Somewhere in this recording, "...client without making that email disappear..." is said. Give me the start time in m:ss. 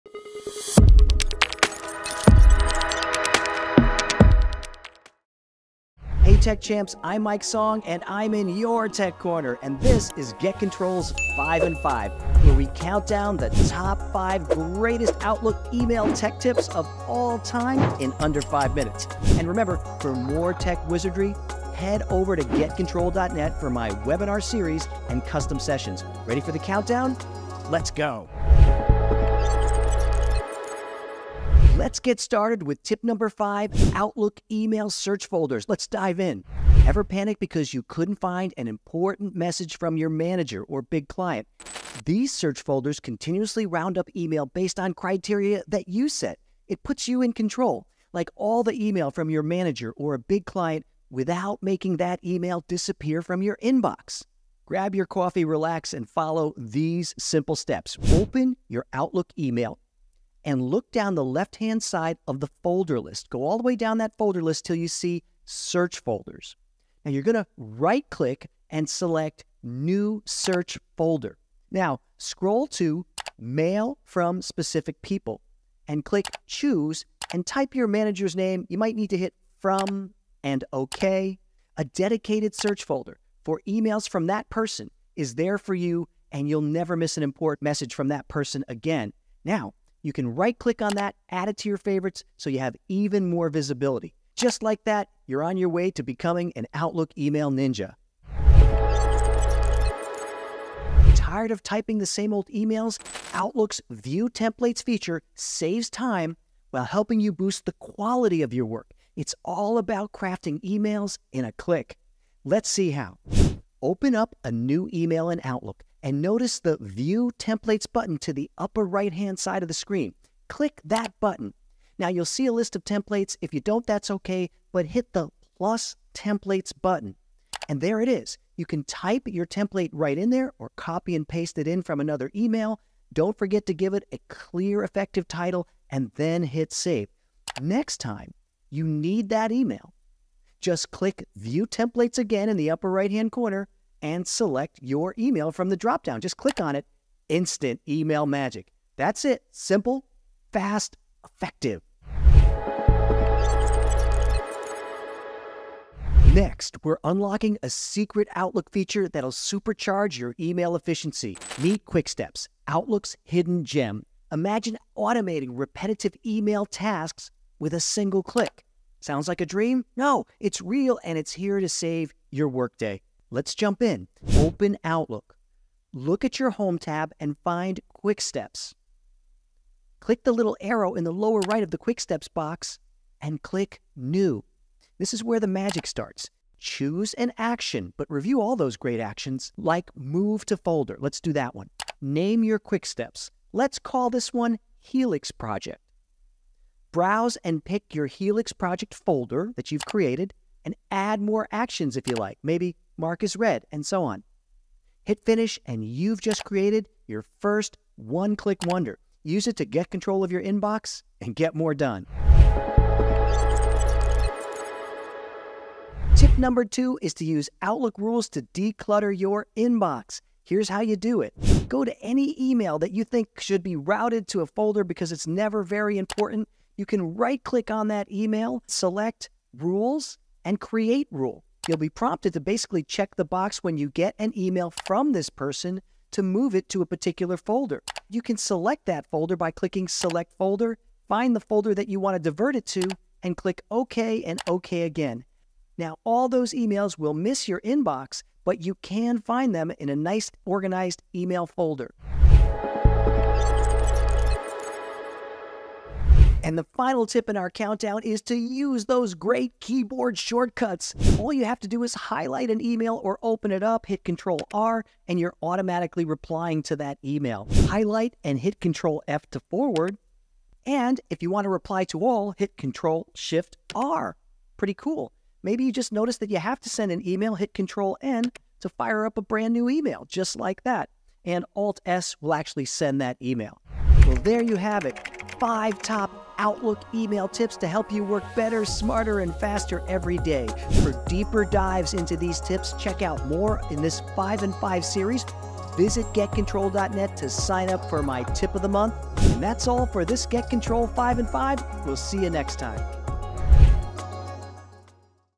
0:50.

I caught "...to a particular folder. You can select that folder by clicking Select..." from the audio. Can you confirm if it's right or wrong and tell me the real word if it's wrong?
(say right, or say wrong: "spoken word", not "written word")
right.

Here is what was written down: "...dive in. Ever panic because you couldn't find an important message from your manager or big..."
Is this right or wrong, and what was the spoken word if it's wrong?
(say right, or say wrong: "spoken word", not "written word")
right.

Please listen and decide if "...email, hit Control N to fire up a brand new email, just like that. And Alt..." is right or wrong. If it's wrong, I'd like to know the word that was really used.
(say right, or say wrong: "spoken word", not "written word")
right.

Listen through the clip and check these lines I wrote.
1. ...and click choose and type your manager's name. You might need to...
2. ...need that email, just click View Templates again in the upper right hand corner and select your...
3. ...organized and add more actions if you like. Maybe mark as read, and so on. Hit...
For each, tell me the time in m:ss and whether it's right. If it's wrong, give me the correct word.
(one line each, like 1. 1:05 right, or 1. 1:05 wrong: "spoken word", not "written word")
1. 1:15 right
2. 2:18 right
3. 3:19 wrong: "created", not "organized".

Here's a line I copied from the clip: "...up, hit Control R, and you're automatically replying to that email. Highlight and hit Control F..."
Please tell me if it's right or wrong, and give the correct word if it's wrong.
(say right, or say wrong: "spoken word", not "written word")
right.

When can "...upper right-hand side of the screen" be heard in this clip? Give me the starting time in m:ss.
1:58.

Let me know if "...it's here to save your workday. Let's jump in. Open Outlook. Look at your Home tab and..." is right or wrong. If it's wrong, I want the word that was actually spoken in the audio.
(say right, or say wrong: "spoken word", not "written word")
right.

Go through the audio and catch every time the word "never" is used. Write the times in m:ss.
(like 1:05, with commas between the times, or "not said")
1:26, 3:45.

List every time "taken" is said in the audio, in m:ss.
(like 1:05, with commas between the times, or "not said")
not said.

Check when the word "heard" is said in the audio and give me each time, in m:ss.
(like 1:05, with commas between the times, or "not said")
not said.